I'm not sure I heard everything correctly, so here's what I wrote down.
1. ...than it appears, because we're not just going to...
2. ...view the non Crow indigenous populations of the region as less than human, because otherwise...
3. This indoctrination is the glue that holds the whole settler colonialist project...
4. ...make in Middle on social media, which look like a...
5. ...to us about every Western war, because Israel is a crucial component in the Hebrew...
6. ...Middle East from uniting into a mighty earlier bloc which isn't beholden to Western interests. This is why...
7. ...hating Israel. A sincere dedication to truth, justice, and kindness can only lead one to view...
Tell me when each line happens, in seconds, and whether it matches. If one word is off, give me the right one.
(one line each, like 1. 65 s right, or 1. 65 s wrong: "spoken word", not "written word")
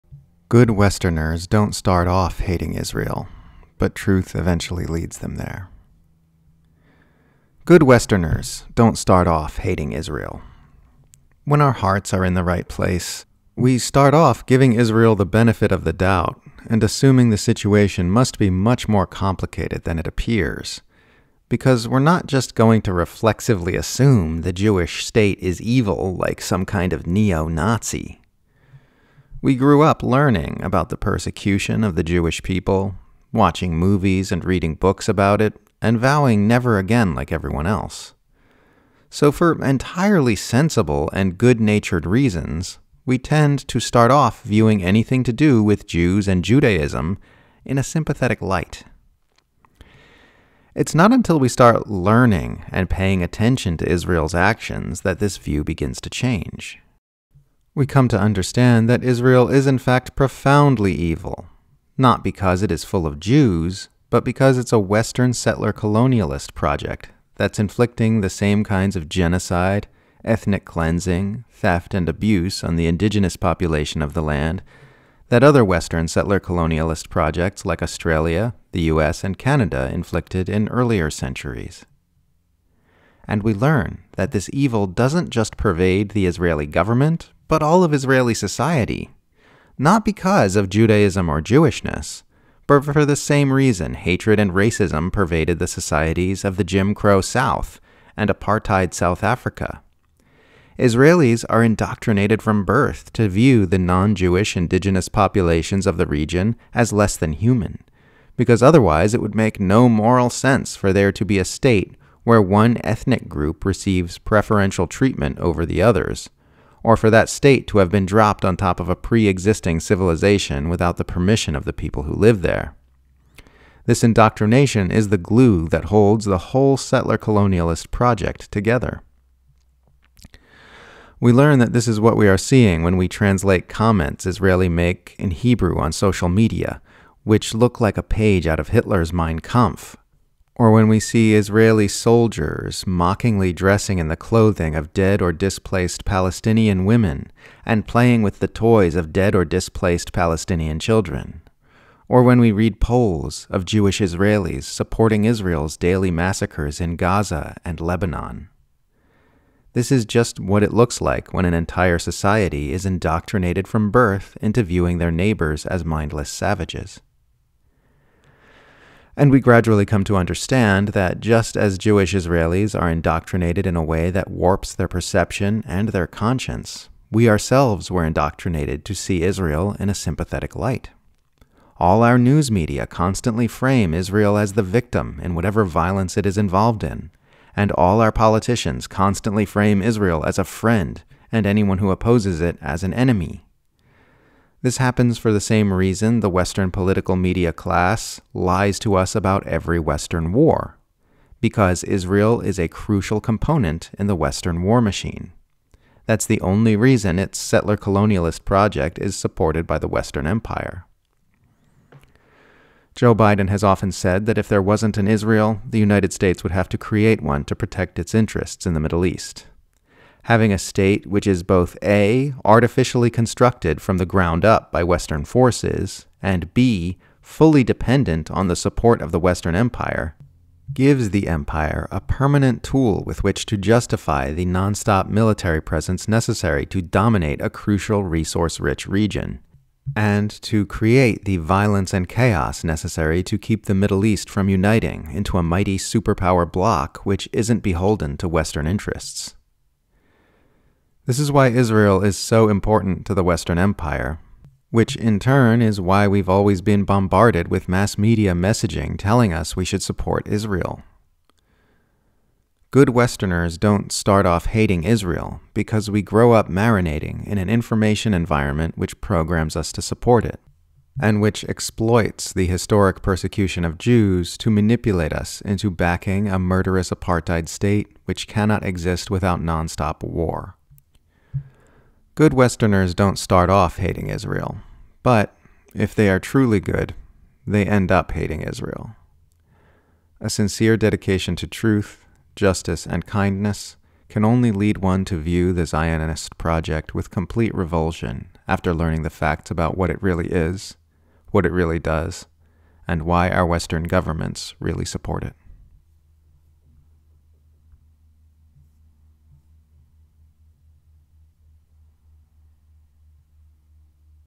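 1. 19 s right
2. 103 s wrong: "Jewish", not "Crow"
3. 123 s right
4. 134 s wrong: "Hebrew", not "Middle"
5. 198 s wrong: "Western", not "Hebrew"
6. 243 s wrong: "superpower", not "earlier"
7. 288 s right.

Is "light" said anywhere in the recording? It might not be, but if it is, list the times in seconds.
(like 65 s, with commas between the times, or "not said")
48 s, 180 s.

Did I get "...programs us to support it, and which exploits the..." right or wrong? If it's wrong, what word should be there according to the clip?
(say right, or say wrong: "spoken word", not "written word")
right.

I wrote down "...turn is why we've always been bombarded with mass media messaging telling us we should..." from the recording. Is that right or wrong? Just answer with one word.
right.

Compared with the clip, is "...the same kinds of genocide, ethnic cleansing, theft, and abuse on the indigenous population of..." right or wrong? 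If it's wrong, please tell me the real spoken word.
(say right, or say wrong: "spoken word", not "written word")
right.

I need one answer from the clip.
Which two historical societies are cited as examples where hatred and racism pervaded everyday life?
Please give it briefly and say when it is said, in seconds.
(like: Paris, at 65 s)
Jim Crow South and apartheid South Africa, at 96 s.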